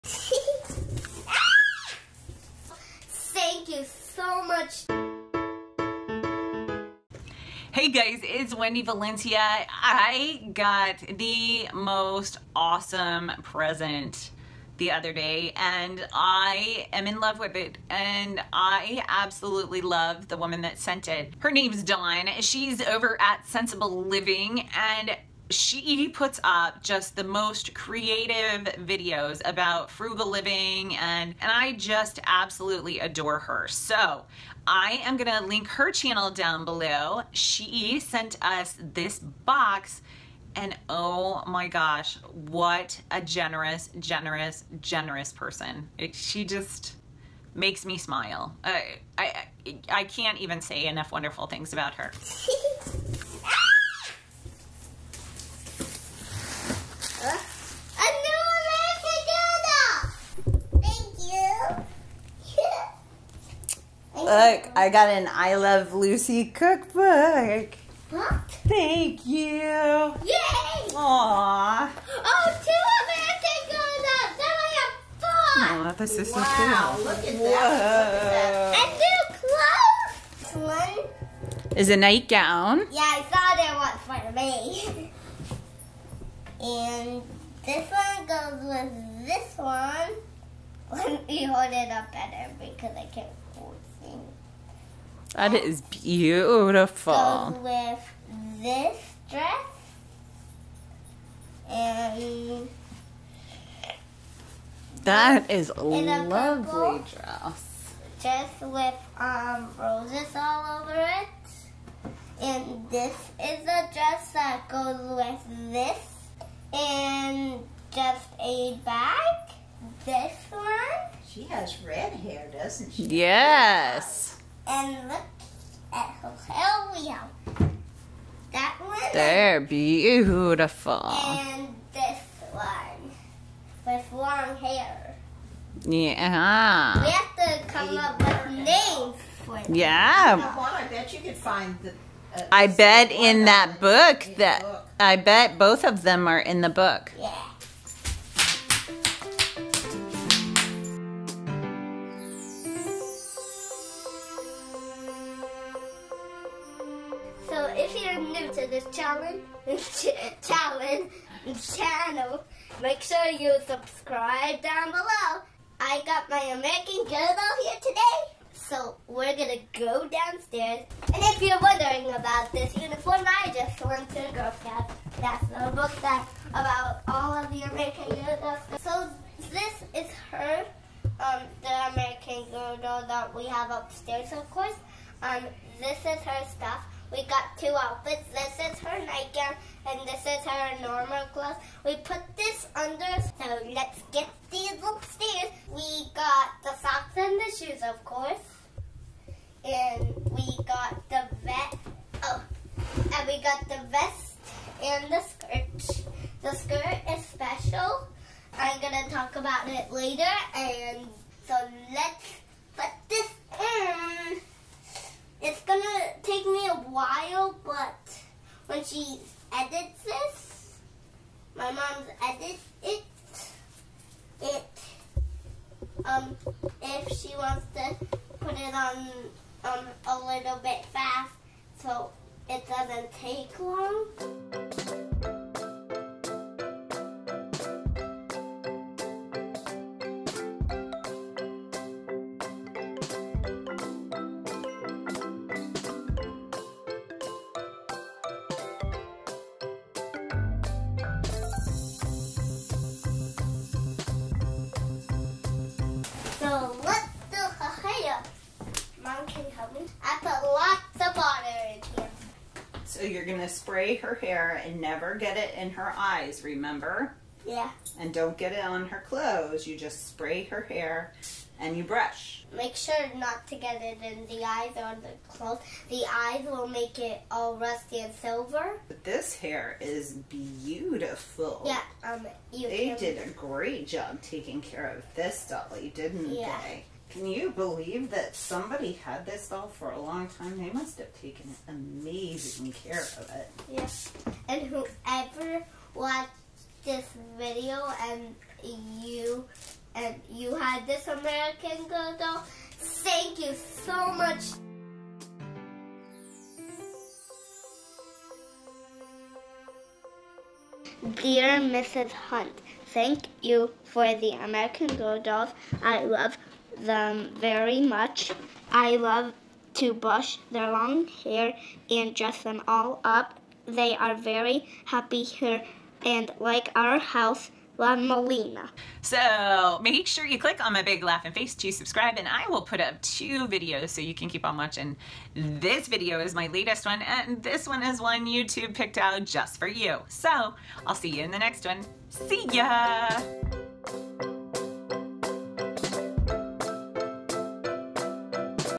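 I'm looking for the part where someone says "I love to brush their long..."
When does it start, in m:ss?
5:18.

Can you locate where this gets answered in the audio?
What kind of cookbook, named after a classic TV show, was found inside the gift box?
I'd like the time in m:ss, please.
1:05.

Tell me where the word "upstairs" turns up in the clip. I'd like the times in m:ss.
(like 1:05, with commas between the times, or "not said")
3:03, 3:14.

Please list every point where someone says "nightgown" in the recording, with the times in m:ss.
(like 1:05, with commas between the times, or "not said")
1:21, 3:09.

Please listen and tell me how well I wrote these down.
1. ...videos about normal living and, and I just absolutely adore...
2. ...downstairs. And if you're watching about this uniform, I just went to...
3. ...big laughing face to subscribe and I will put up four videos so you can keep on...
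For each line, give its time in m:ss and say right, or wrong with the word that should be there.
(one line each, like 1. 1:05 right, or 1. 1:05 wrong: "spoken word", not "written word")
1. 0:28 wrong: "frugal", not "normal"
2. 2:50 wrong: "wondering", not "watching"
3. 5:30 wrong: "two", not "four".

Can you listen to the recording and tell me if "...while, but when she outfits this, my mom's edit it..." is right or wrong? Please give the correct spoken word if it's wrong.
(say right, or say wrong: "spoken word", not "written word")
wrong: "edits", not "outfits".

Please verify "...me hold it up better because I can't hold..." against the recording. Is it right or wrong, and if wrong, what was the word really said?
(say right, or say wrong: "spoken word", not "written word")
right.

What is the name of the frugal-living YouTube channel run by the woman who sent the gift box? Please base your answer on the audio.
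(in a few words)
Centsible Living.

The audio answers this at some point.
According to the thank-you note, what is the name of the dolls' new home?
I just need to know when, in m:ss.
5:27.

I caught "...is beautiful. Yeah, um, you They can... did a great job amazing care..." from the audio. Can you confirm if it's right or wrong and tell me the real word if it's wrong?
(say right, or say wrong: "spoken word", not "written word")
wrong: "taking", not "amazing".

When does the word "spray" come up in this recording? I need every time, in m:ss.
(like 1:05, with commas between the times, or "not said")
4:23, 4:30.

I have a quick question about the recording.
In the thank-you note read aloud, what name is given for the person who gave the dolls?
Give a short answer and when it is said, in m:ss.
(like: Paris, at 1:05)
Mrs. Hunt, at 5:11.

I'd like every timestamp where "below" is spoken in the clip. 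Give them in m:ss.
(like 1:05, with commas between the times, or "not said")
0:36, 2:44.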